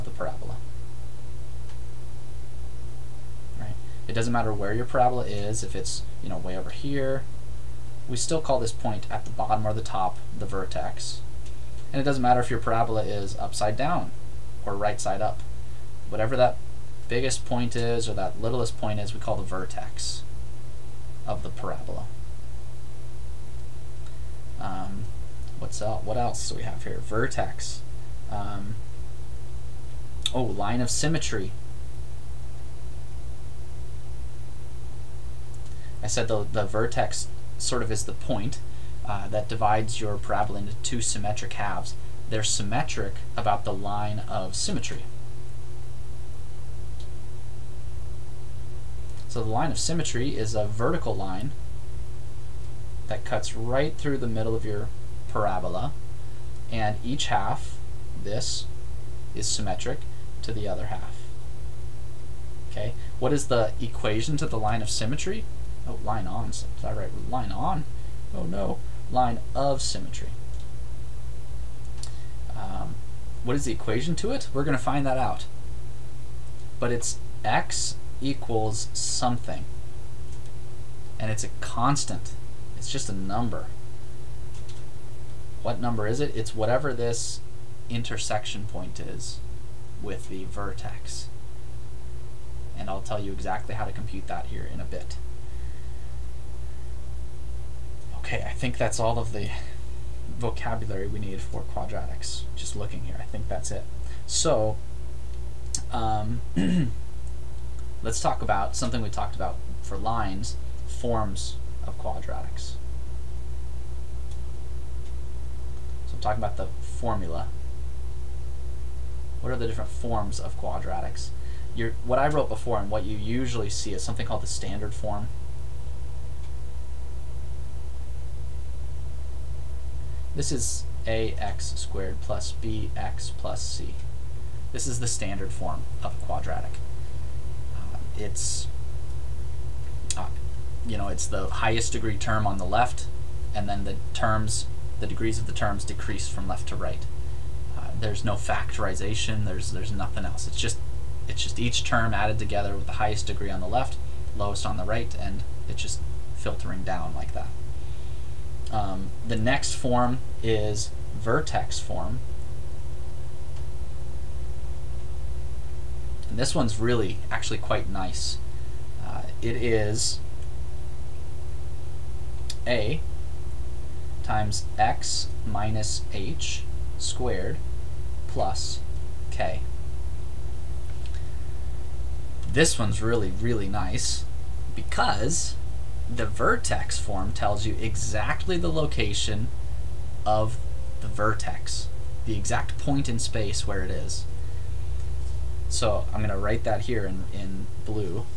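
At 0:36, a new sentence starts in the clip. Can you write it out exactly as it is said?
I said the, the vertex sort of is the point uh, that divides your parabola into two symmetric halves.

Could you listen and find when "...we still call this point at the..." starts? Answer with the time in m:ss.
0:08.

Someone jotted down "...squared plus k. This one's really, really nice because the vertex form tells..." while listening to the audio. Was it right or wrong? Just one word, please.
right.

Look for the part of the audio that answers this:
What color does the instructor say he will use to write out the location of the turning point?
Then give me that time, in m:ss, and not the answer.
3:17.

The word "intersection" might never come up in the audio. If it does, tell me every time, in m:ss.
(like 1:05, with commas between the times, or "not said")
1:27.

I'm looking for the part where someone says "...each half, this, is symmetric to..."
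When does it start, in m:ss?
0:57.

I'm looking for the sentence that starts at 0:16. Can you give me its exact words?
Whatever that biggest point is or that littlest point is, we call the vertex of the parabola.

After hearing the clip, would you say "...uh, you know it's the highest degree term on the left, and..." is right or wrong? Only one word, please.
right.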